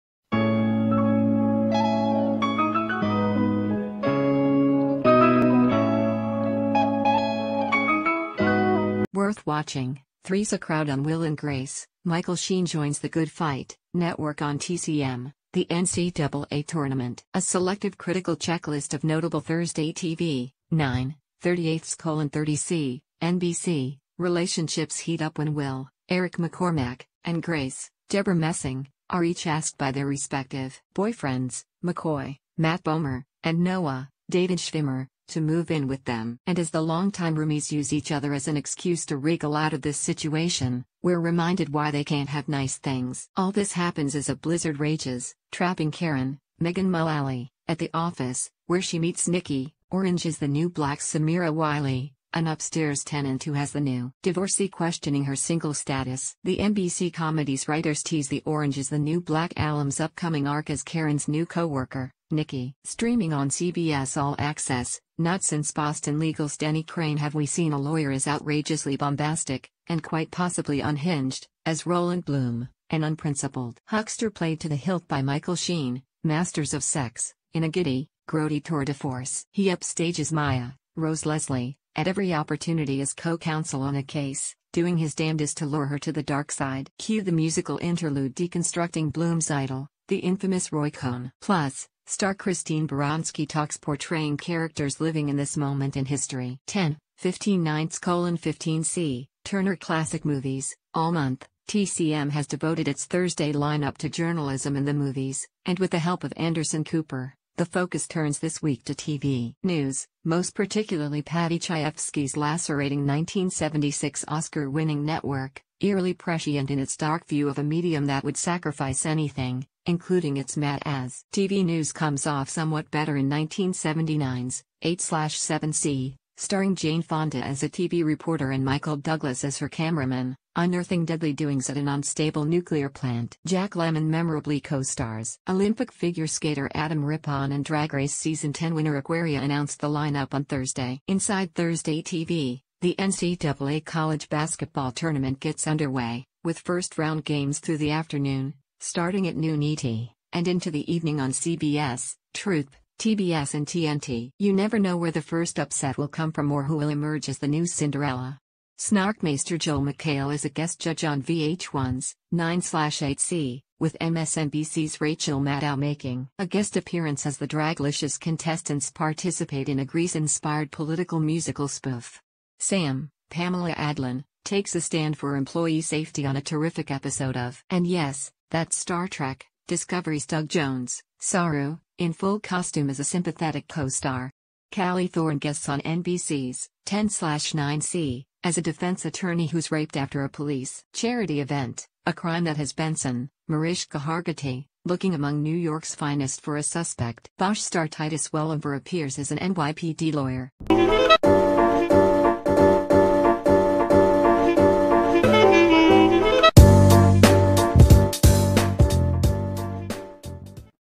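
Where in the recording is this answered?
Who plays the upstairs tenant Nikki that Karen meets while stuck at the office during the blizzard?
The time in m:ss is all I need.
0:50.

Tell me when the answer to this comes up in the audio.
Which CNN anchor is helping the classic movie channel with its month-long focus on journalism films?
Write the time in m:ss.
1:46.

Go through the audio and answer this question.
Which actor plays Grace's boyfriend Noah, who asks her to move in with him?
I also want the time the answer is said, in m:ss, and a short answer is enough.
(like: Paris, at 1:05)
David Schwimmer, at 0:34.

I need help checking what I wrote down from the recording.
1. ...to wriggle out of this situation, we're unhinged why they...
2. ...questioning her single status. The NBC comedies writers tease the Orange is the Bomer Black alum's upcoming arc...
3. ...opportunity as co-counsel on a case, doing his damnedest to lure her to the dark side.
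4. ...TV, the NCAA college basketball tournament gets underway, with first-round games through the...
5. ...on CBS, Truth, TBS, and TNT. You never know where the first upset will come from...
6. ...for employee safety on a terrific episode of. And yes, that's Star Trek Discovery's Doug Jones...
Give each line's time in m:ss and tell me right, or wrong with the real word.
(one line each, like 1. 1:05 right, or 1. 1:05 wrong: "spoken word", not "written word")
1. 0:39 wrong: "reminded", not "unhinged"
2. 0:54 wrong: "New", not "Bomer"
3. 1:22 right
4. 2:22 right
5. 2:31 right
6. 2:55 right.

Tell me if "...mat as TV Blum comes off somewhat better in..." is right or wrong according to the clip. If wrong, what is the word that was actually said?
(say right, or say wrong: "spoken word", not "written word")
wrong: "News", not "Blum".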